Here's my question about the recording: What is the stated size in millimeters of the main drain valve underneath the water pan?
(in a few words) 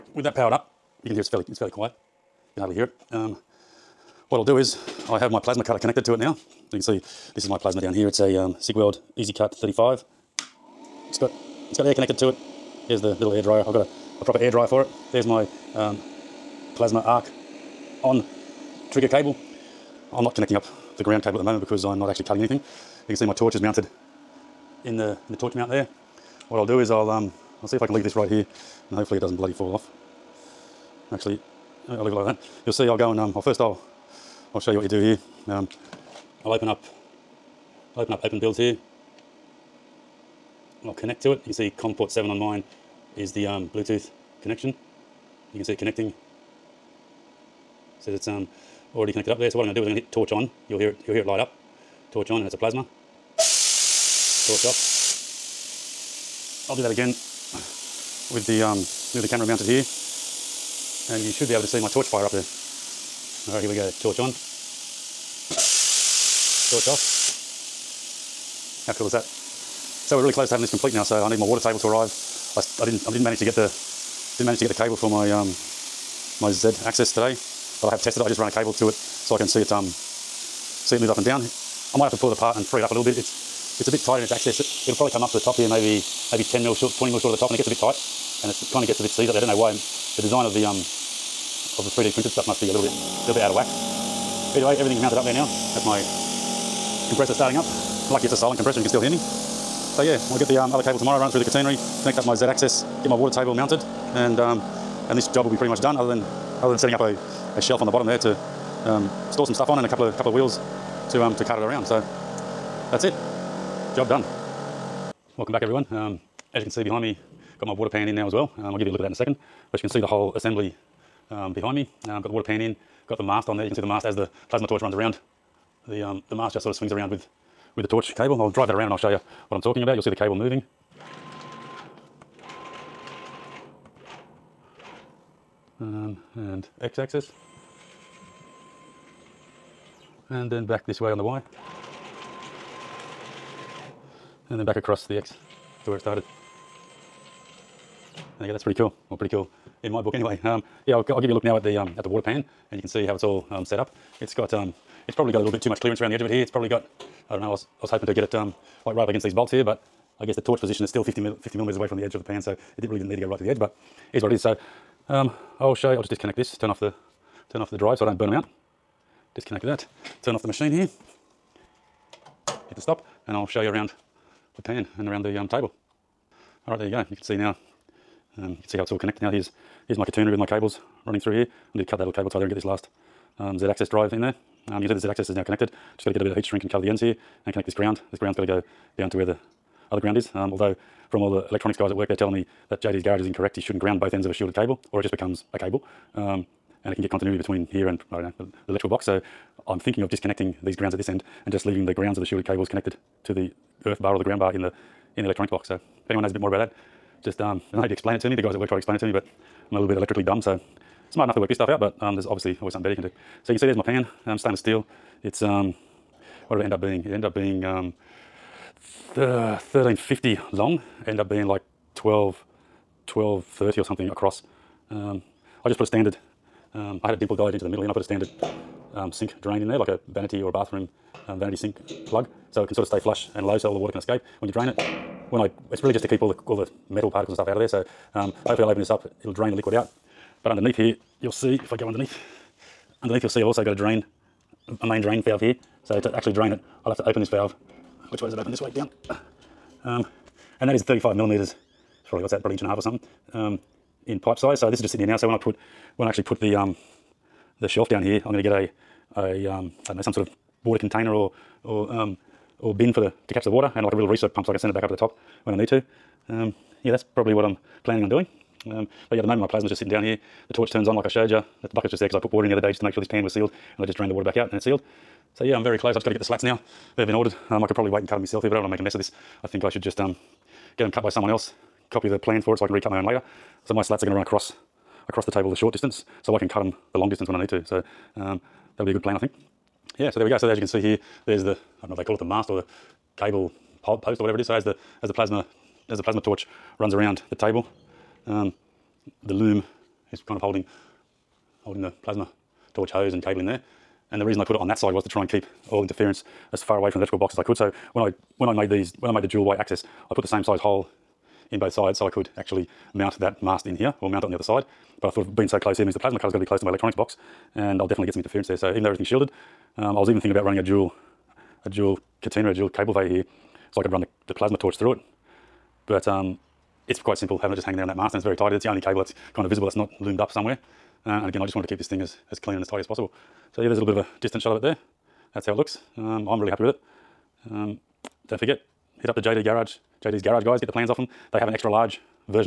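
35 millimeters.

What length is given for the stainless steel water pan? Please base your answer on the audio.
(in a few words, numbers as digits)
1350.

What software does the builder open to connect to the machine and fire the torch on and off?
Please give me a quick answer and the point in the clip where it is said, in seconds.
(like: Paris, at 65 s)
OpenBuilds, at 38 s.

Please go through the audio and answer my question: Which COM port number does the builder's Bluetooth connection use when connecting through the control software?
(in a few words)
7.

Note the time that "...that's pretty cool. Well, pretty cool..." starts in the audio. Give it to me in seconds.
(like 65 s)
148 s.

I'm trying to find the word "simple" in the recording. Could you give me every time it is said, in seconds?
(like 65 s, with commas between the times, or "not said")
327 s.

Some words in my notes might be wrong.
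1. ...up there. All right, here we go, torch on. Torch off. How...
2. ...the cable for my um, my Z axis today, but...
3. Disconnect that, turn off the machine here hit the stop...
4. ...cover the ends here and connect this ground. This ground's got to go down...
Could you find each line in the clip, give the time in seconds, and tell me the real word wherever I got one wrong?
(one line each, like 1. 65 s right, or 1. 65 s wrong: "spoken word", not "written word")
1. 62 s right
2. 74 s right
3. 169 s right
4. 186 s right.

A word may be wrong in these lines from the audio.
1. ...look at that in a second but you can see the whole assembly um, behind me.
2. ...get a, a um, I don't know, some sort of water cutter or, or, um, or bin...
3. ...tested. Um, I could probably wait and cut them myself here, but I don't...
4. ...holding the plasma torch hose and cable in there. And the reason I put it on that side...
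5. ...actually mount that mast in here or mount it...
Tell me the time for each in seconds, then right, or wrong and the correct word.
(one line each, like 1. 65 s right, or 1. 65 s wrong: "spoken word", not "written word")
1. 118 s right
2. 258 s wrong: "container", not "cutter"
3. 277 s wrong: "ordered", not "tested"
4. 301 s right
5. 312 s right.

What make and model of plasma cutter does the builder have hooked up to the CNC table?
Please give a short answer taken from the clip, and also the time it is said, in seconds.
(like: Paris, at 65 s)
Cigweld Easy Cut 35, at 8 s.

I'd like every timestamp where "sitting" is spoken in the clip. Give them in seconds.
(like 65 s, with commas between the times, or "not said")
254 s, 269 s.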